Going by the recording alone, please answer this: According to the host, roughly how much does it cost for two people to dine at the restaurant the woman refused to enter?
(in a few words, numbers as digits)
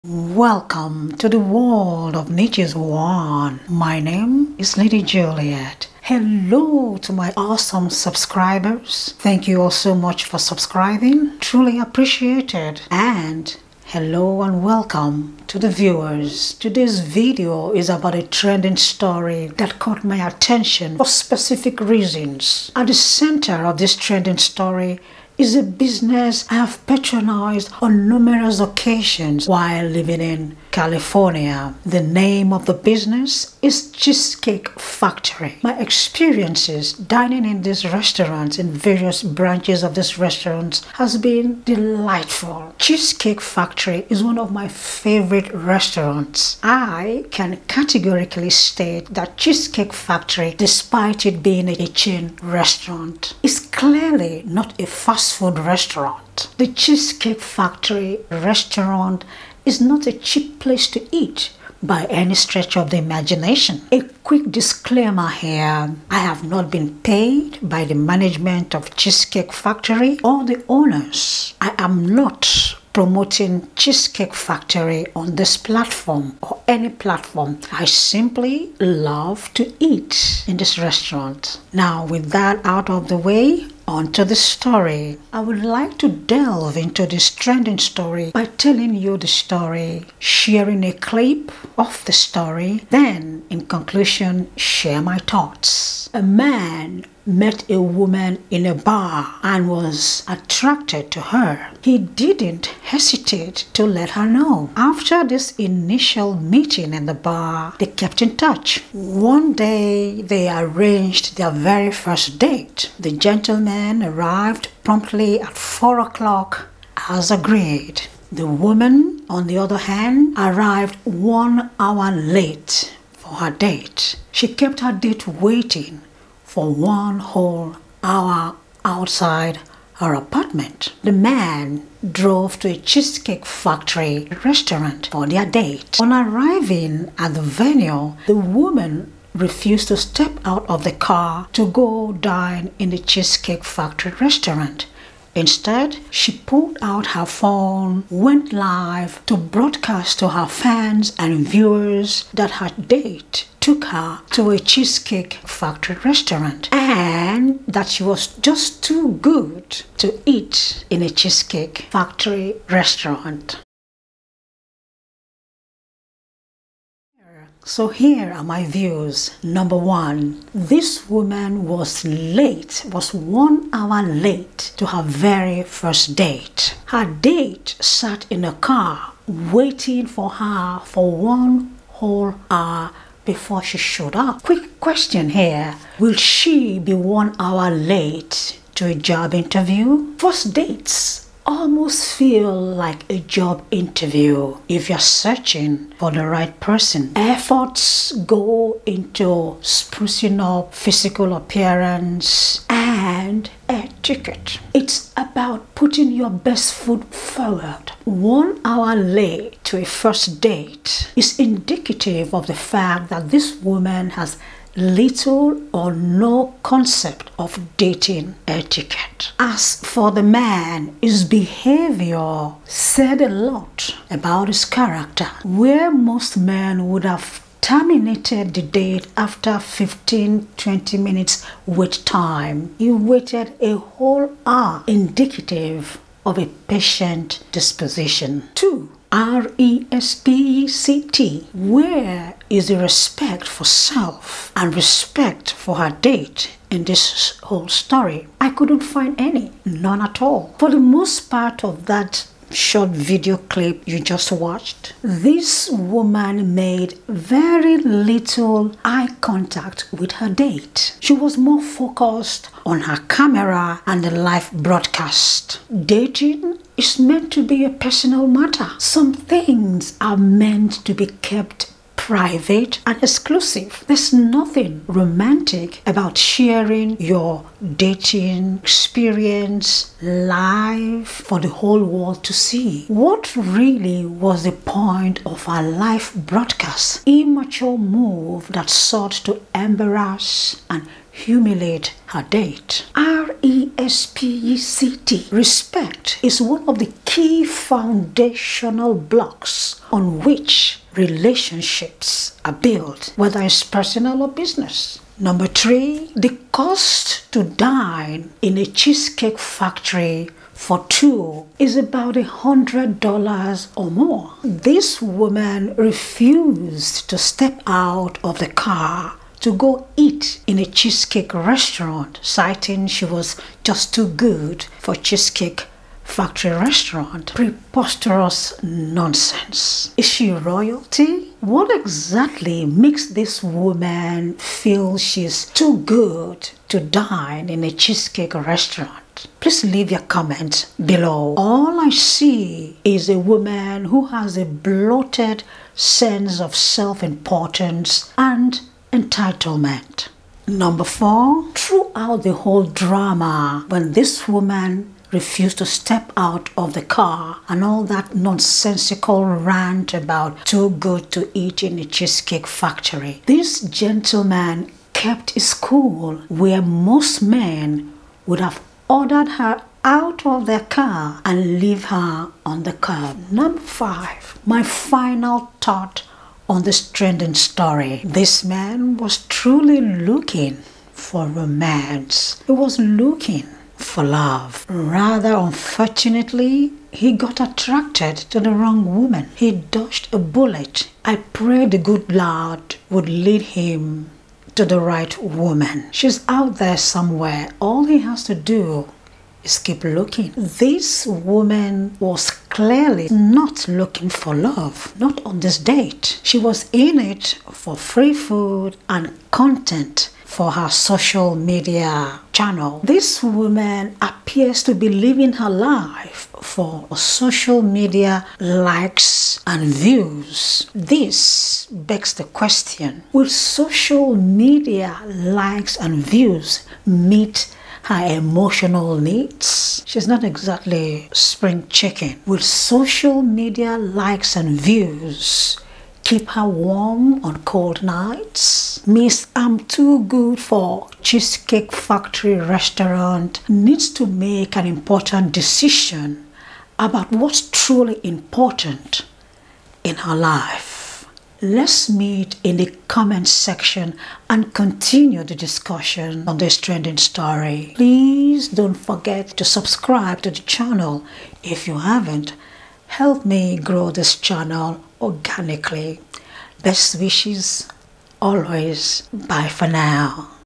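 $100.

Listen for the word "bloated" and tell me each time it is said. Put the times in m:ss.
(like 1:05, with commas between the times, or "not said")
5:44.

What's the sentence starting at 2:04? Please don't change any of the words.
She kept her date waiting for one whole hour outside her apartment.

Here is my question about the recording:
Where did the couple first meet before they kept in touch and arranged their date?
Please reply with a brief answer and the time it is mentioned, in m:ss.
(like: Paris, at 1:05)
A bar, at 1:38.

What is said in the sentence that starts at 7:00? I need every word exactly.
This begs the question, will social media likes and views meet her emotional needs.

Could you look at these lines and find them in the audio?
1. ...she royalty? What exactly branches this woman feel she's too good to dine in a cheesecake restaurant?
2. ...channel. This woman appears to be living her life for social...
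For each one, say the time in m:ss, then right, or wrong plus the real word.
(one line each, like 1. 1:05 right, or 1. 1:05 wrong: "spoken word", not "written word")
1. 5:30 wrong: "makes", not "branches"
2. 6:52 right.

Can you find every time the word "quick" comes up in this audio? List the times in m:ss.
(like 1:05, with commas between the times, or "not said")
1:04, 3:04.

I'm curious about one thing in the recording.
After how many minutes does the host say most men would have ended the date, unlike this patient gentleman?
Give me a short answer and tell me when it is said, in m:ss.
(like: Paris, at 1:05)
15 to 20 minutes, at 3:49.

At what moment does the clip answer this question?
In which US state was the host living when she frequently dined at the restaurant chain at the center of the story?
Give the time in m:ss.
0:30.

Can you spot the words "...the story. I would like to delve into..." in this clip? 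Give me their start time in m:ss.
1:24.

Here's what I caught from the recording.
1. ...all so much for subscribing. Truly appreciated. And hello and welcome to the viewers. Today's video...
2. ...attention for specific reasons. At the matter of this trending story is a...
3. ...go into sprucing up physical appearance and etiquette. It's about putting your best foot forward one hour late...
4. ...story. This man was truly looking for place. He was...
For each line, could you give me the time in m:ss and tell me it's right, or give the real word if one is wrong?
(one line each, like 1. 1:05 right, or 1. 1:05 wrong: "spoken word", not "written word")
1. 0:09 right
2. 0:20 wrong: "center", not "matter"
3. 3:18 right
4. 6:17 wrong: "romance", not "place".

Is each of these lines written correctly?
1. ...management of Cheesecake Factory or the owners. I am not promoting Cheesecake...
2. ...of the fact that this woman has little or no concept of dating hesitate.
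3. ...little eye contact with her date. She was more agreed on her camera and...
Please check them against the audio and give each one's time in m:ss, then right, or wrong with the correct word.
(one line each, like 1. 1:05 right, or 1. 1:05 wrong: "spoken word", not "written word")
1. 1:07 right
2. 3:32 wrong: "etiquette", not "hesitate"
3. 4:17 wrong: "focused", not "agreed".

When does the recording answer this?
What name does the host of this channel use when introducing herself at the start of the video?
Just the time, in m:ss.
0:04.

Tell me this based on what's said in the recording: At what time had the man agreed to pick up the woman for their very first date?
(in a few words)
4 o'clock.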